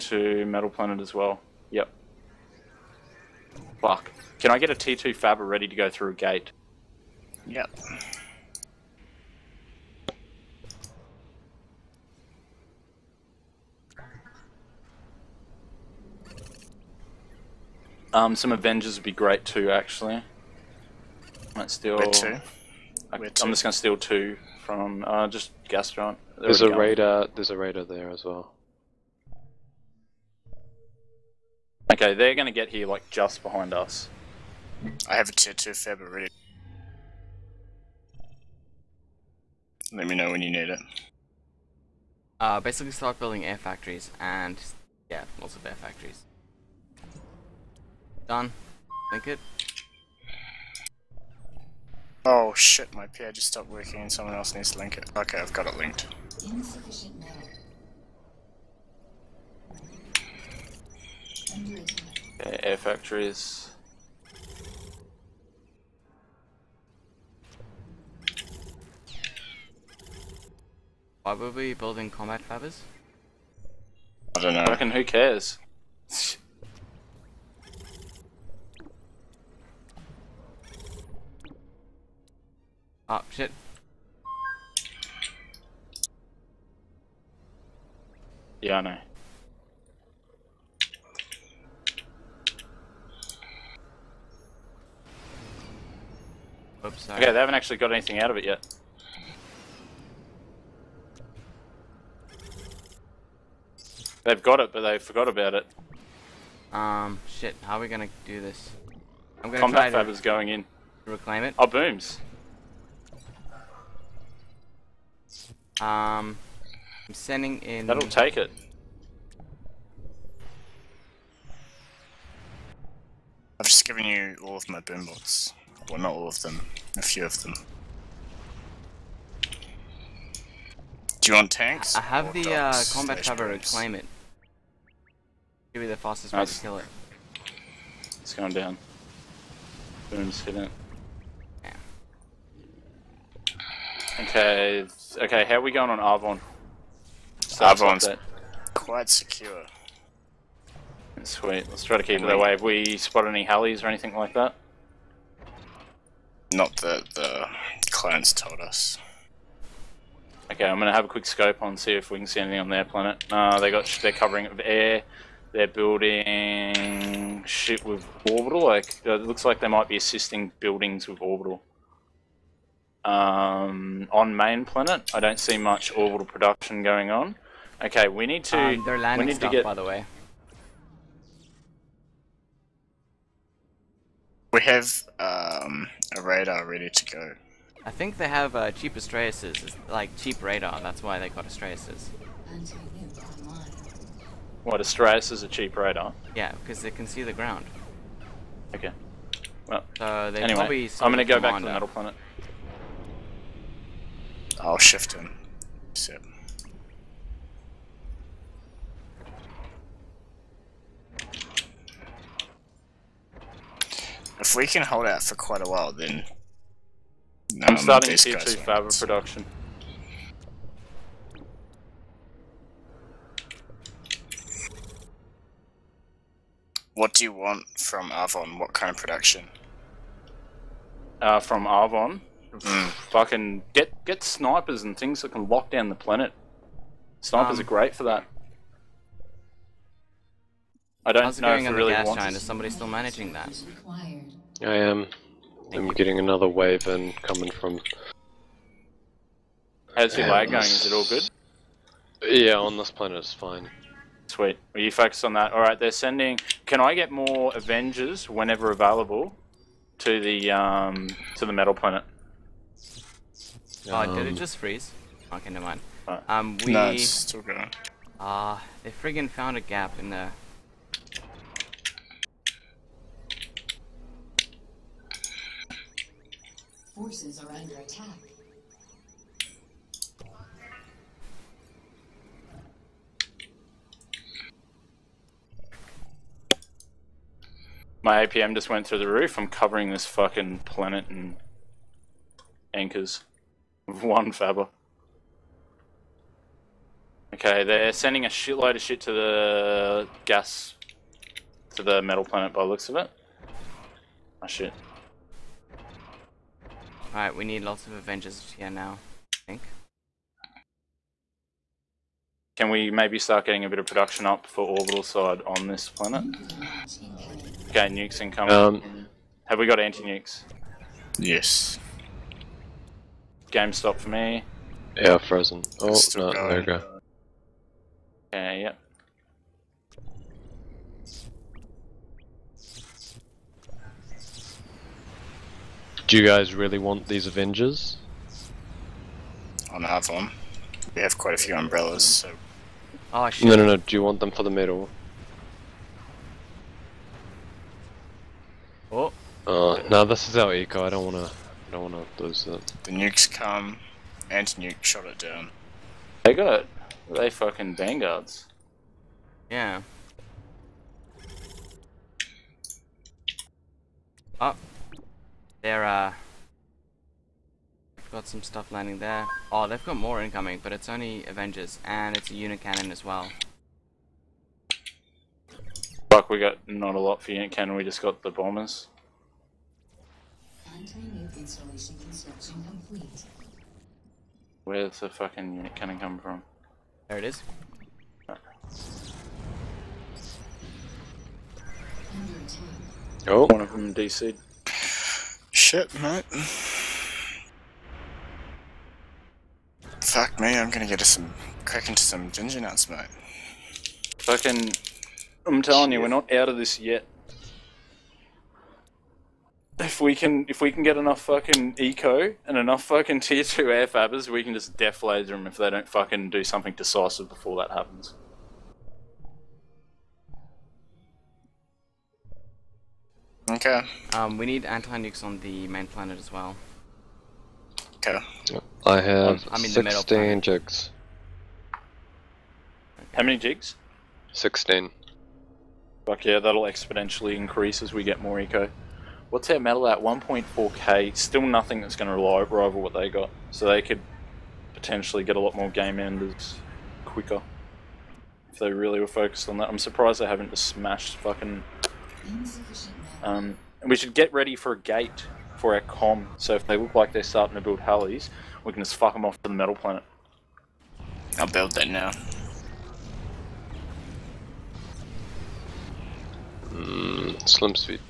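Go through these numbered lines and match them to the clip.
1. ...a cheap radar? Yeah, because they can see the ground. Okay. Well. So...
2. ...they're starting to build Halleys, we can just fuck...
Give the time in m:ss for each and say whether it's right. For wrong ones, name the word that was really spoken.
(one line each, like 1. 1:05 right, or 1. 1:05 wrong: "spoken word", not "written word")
1. 3:15 right
2. 7:37 right.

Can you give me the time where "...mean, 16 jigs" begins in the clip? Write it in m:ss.
7:09.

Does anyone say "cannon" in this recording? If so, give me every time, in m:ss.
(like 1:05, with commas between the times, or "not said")
6:12, 6:17.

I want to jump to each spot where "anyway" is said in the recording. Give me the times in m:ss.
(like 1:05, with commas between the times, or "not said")
3:20.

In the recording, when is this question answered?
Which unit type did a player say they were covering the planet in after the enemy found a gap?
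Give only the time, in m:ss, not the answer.
4:52.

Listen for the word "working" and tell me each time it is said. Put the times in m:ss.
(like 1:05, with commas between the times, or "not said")
0:53.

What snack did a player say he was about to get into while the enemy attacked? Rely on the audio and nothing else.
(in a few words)
ginger nuts.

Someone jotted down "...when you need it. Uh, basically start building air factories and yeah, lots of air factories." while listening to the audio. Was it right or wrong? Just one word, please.
right.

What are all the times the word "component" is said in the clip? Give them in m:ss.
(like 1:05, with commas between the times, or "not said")
not said.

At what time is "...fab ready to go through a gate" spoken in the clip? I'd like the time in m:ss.
0:05.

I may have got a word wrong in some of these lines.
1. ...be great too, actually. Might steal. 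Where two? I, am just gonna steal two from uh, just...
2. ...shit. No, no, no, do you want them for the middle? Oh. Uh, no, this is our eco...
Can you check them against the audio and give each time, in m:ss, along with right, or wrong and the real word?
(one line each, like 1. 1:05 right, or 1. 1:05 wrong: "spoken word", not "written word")
1. 0:19 right
2. 5:43 right.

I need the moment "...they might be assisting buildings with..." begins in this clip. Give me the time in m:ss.
2:49.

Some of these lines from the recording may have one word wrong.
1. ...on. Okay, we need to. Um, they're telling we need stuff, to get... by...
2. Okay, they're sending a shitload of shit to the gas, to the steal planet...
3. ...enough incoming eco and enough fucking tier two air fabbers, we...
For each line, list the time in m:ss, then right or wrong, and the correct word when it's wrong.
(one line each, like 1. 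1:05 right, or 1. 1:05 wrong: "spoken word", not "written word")
1. 2:57 wrong: "landing", not "telling"
2. 4:57 wrong: "metal", not "steal"
3. 6:50 wrong: "fucking", not "incoming".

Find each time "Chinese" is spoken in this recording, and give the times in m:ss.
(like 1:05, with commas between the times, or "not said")
not said.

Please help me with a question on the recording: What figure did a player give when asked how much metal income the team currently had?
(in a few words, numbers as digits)
1.4k.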